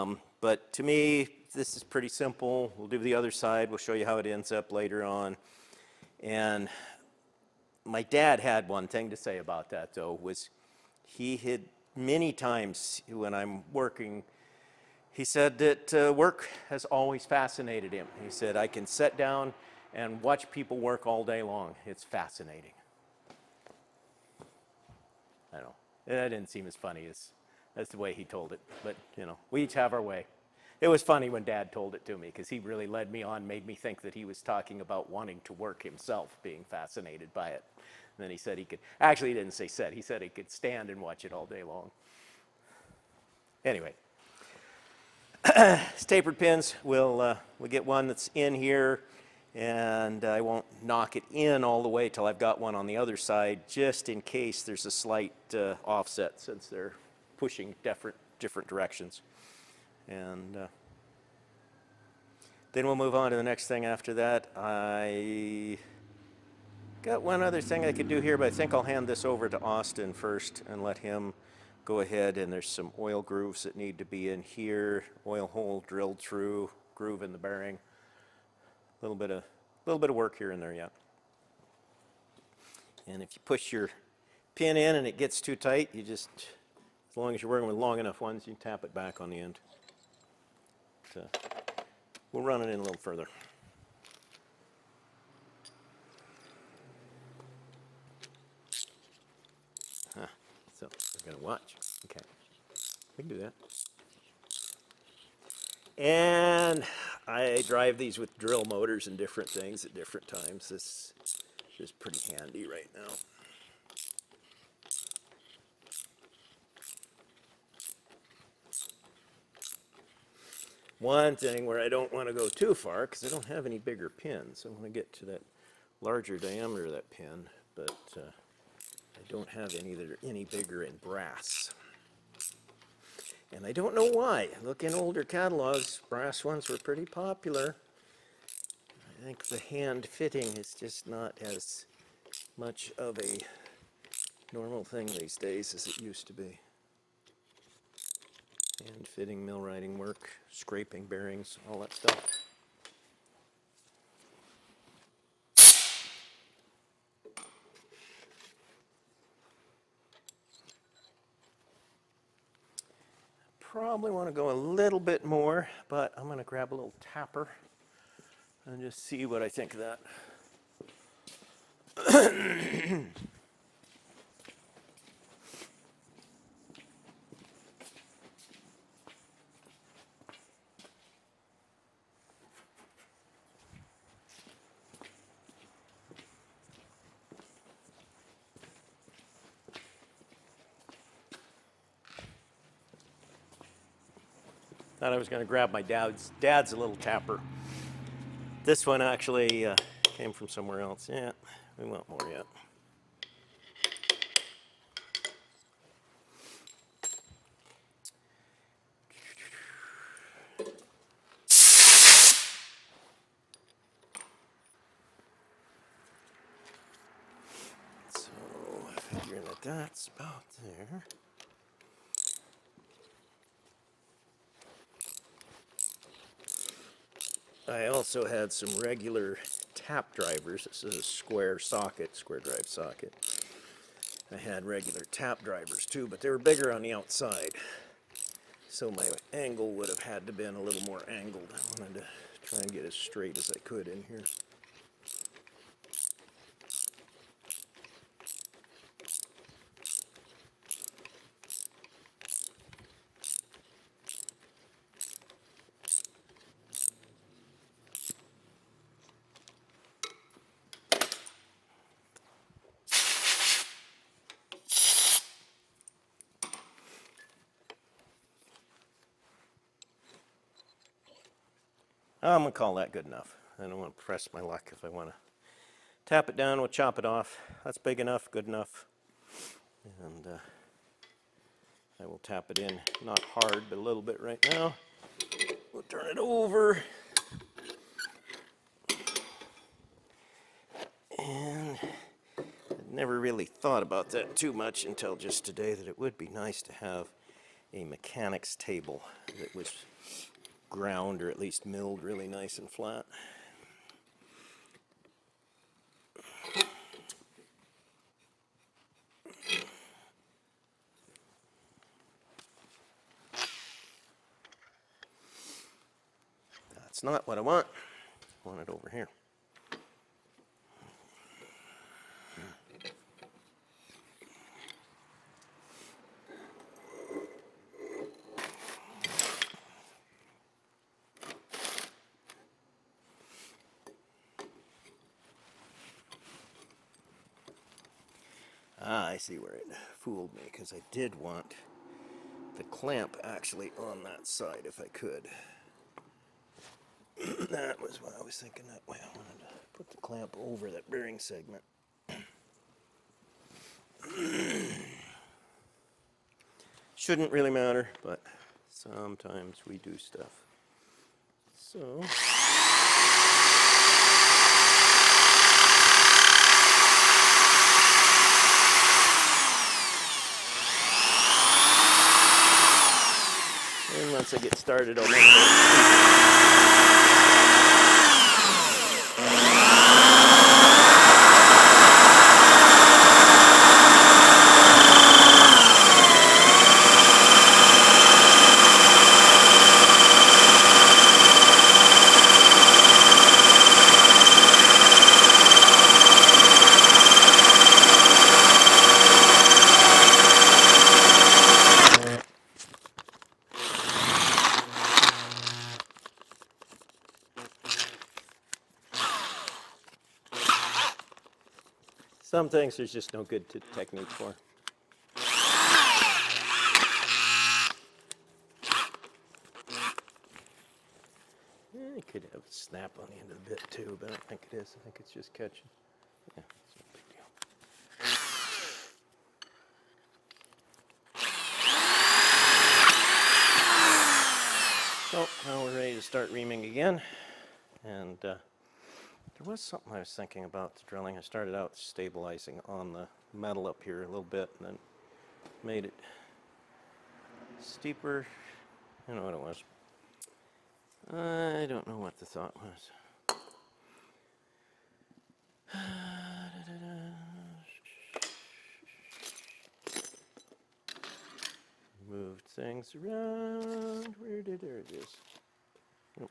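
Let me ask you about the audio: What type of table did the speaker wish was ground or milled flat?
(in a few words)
Mechanics table.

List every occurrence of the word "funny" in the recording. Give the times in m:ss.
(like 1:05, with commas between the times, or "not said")
0:26, 0:31.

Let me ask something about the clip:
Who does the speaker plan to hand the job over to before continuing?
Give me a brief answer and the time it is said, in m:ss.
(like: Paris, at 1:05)
Austin, at 1:09.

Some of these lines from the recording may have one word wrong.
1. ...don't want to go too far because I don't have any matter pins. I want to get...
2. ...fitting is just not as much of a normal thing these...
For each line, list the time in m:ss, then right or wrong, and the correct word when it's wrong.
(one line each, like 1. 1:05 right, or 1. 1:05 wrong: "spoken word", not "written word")
1. 2:01 wrong: "bigger", not "matter"
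2. 2:20 right.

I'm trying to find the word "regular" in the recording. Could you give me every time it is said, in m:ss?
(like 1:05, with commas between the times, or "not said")
3:48, 3:54.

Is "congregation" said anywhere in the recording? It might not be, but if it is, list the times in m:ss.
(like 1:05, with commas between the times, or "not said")
not said.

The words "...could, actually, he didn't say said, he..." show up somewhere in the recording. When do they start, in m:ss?
0:38.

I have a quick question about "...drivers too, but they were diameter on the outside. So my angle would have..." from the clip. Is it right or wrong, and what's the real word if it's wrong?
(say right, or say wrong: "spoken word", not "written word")
wrong: "bigger", not "diameter".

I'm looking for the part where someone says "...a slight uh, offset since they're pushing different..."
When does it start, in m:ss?
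0:54.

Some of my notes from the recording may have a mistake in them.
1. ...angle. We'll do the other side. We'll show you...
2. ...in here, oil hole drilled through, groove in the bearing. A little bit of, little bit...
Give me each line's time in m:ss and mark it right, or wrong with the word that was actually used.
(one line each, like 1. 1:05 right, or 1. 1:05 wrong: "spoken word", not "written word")
1. 0:02 wrong: "simple", not "angle"
2. 1:14 right.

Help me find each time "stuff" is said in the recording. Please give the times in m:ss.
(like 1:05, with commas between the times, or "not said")
2:31, 5:59.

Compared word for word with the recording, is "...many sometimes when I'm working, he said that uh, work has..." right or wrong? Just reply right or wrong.
wrong.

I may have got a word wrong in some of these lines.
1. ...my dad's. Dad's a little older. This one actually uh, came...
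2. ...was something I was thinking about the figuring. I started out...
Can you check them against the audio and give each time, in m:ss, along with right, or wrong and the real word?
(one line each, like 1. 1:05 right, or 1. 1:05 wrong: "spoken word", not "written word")
1. 3:15 wrong: "tapper", not "older"
2. 7:19 wrong: "drilling", not "figuring".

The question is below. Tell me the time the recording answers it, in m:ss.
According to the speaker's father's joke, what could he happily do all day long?
0:20.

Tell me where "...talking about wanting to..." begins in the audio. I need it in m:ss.
0:34.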